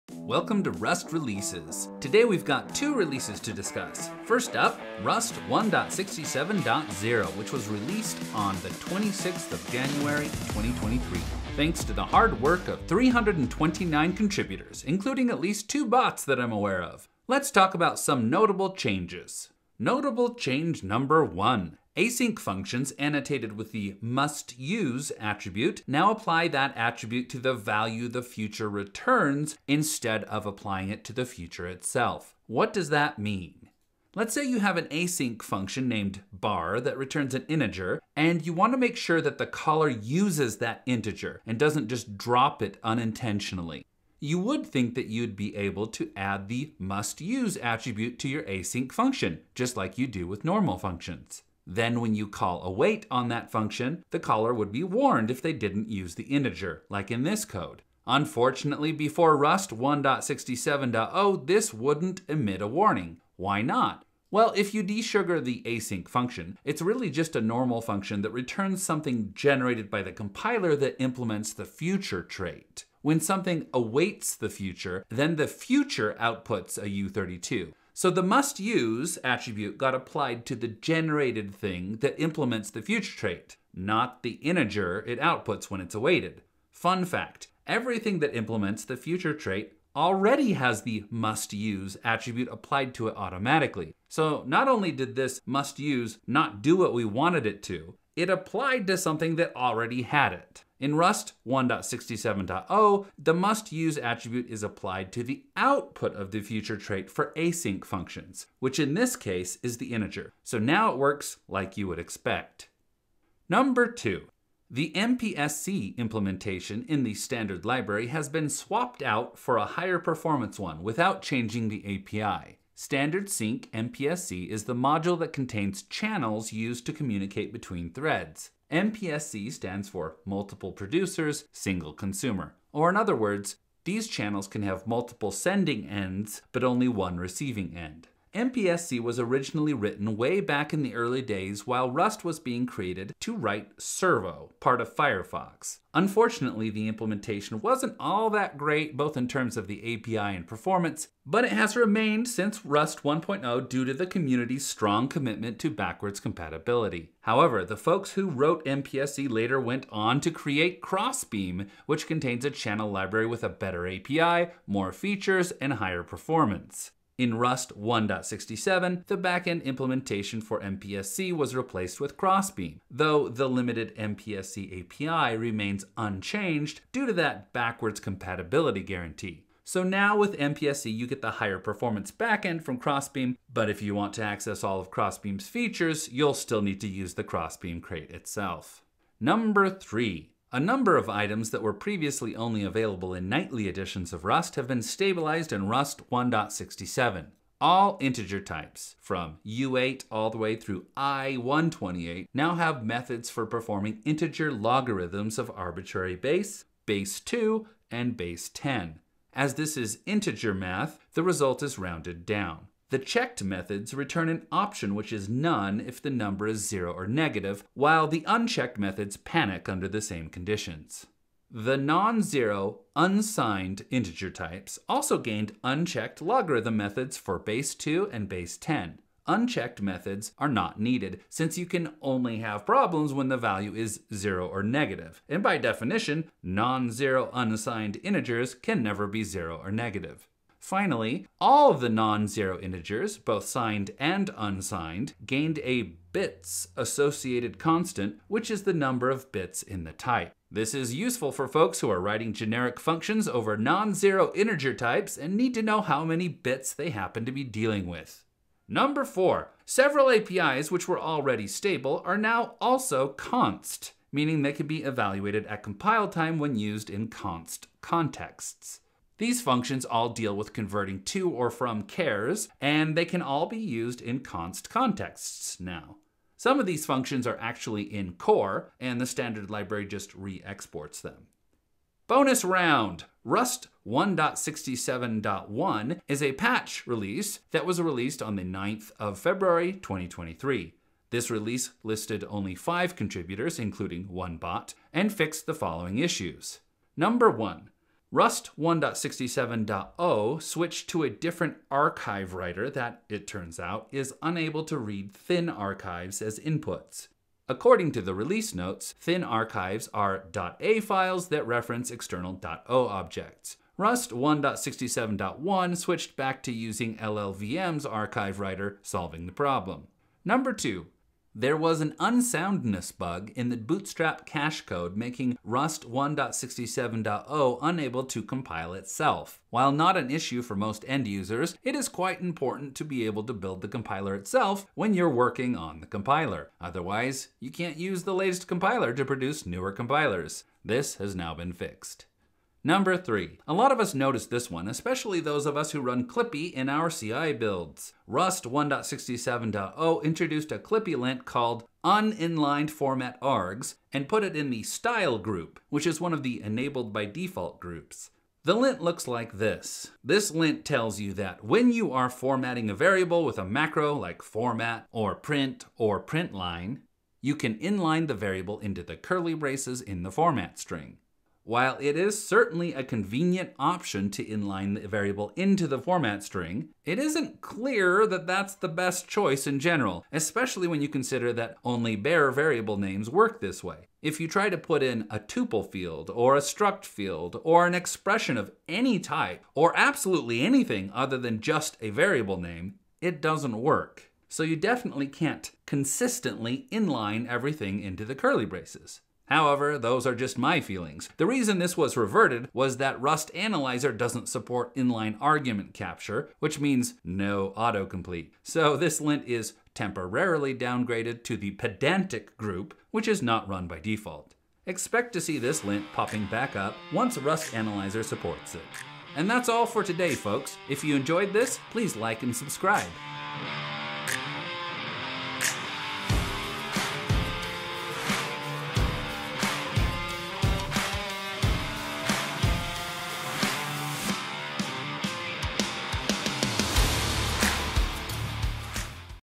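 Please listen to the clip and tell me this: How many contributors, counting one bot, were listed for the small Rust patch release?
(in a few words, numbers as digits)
5.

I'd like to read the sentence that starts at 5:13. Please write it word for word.
Rust 1.67.1 switched back to using LLVM's archive writer, solving the problem.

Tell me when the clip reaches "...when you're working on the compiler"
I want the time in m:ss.
5:34.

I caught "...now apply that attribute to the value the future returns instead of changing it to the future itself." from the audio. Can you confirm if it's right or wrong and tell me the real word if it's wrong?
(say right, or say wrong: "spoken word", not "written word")
wrong: "applying", not "changing".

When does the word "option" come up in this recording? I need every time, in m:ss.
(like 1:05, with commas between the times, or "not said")
3:34, 6:13.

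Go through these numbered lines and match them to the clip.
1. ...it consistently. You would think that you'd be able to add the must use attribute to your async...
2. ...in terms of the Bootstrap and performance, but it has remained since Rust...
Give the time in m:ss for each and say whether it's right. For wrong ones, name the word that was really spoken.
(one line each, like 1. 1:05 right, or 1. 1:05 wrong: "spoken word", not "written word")
1. 0:42 wrong: "unintentionally", not "consistently"
2. 2:29 wrong: "API", not "Bootstrap".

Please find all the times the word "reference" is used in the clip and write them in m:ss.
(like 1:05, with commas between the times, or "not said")
5:11.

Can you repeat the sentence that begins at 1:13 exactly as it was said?
When something awaits the future, then the future outputs a U32.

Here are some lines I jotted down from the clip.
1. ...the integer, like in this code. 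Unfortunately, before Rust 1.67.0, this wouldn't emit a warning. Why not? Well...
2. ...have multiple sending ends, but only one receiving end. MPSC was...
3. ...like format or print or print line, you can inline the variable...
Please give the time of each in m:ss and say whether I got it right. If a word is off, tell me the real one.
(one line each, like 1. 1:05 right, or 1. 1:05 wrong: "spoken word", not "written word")
1. 0:56 right
2. 2:14 right
3. 6:03 right.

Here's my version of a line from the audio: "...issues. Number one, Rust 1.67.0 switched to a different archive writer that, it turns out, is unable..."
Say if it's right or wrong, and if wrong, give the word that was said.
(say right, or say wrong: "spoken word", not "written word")
right.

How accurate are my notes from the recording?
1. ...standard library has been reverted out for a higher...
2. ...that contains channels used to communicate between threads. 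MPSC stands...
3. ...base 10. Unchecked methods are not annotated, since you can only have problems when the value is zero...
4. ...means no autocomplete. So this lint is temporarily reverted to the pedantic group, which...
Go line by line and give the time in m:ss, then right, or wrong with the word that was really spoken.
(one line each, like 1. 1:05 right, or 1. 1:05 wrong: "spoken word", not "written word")
1. 1:57 wrong: "swapped", not "reverted"
2. 2:05 right
3. 3:48 wrong: "needed", not "annotated"
4. 6:46 wrong: "downgraded", not "reverted".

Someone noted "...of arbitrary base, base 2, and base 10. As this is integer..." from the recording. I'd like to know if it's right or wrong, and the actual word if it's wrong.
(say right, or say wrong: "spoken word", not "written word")
right.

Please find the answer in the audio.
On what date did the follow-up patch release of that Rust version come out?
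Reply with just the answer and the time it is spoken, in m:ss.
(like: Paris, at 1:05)
9 February 2023, at 4:48.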